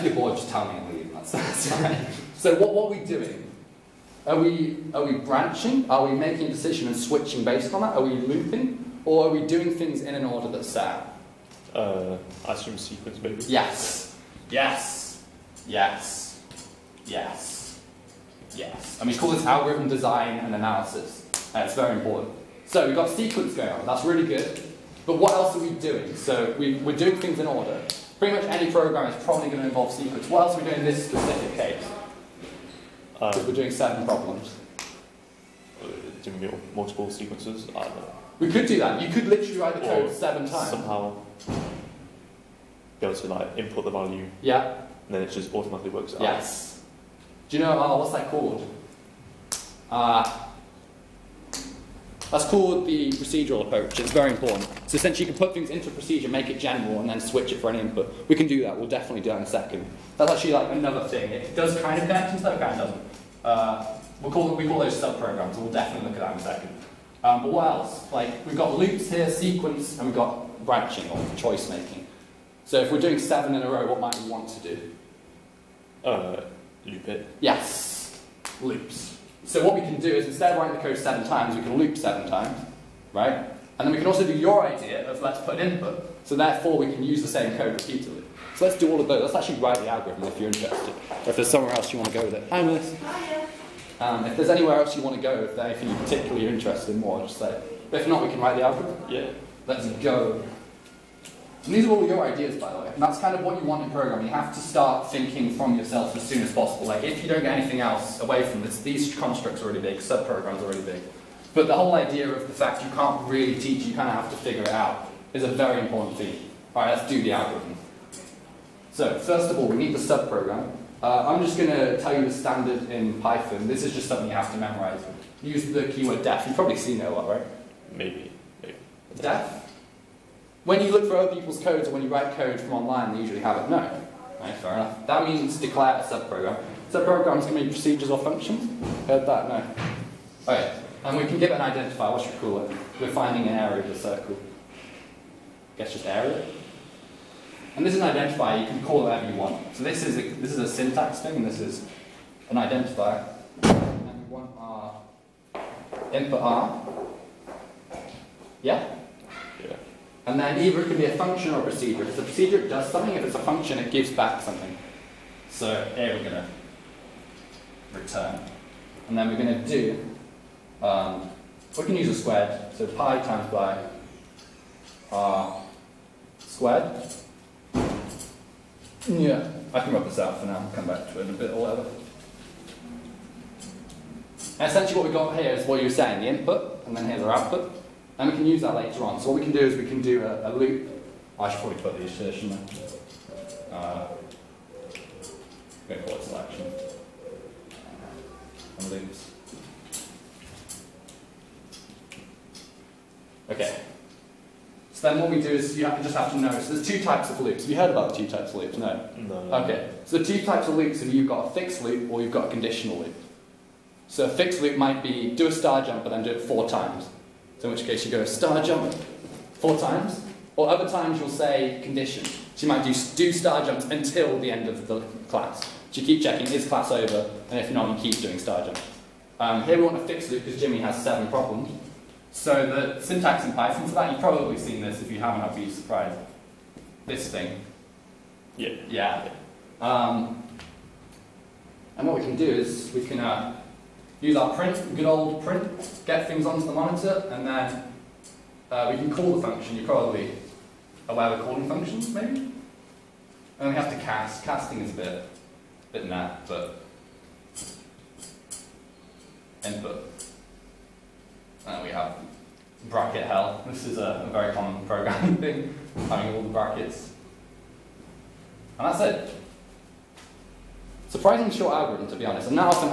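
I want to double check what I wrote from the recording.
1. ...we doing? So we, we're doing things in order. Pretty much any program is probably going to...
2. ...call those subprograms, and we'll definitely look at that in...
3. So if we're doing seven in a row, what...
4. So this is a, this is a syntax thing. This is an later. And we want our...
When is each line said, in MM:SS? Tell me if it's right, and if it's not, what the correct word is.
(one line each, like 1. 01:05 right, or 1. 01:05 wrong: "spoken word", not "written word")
1. 00:25 right
2. 01:04 right
3. 01:12 right
4. 02:29 wrong: "identifier", not "later".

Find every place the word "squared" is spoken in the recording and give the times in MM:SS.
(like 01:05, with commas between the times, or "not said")
02:52, 02:56.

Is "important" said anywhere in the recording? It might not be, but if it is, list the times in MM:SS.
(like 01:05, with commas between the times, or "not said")
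00:21, 00:54, 01:55.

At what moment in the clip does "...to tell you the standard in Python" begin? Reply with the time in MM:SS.
02:01.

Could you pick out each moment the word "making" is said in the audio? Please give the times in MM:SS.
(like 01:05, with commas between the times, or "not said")
00:06, 01:11.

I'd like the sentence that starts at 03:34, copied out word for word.
So a fixed loop might be do a star jump and then do it four times.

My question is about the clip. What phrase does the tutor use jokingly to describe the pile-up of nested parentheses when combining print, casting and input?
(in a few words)
bracket hell.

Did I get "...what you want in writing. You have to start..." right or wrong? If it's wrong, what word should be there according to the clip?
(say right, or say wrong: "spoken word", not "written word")
wrong: "programming", not "writing".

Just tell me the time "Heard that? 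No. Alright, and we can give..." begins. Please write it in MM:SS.
02:19.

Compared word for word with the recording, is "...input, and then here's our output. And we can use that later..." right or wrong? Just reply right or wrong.
right.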